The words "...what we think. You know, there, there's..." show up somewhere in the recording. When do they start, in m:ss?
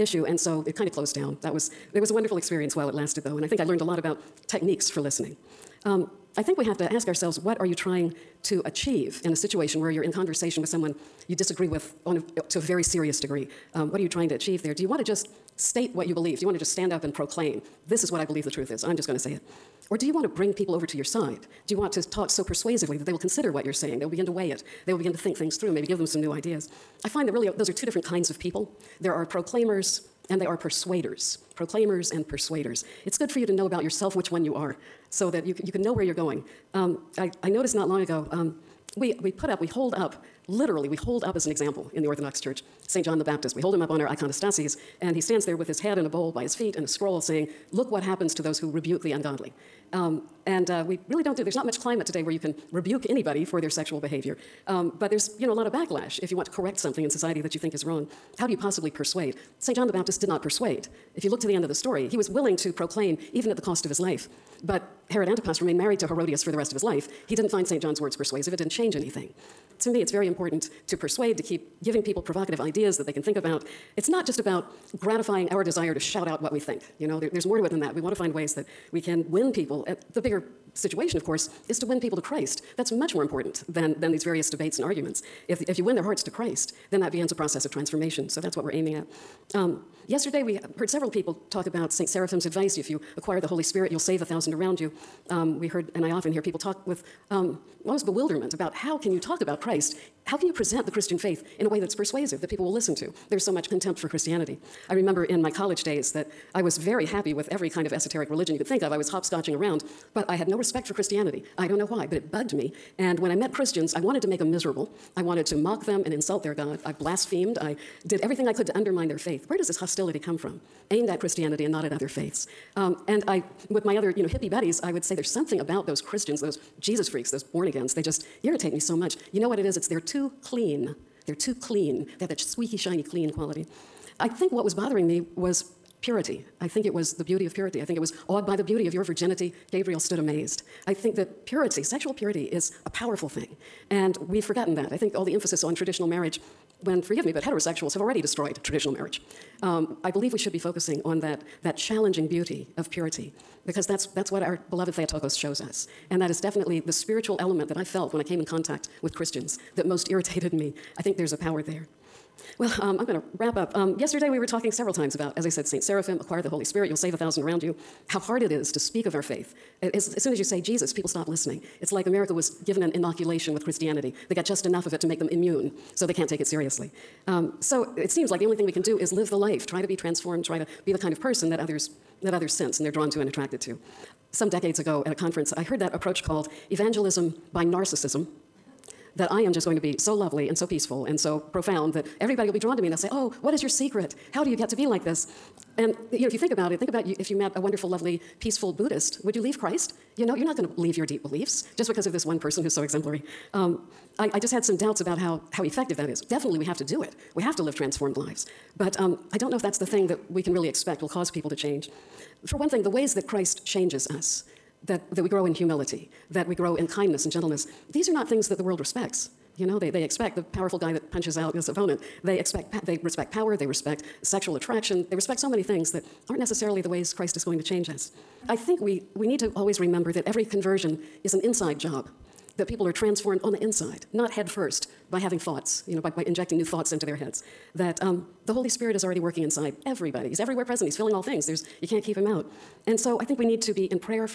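1:16.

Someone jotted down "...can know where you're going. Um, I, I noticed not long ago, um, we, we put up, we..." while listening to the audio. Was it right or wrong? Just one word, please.
right.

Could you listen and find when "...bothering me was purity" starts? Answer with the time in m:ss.
2:14.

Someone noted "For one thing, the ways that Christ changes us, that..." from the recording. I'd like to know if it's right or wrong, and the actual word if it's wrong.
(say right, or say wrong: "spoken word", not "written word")
right.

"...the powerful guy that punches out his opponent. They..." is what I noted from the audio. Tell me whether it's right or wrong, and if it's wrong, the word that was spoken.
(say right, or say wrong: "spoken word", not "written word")
right.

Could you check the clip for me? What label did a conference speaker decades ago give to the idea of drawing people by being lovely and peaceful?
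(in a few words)
evangelism by narcissism.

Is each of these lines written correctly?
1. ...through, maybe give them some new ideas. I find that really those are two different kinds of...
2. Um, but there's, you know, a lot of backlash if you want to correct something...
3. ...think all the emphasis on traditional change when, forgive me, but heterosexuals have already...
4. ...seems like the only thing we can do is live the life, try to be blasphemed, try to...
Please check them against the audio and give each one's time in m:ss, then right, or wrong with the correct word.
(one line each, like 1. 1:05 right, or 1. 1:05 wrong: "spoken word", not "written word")
1. 0:25 right
2. 0:54 right
3. 2:24 wrong: "marriage", not "change"
4. 2:58 wrong: "transformed", not "blasphemed".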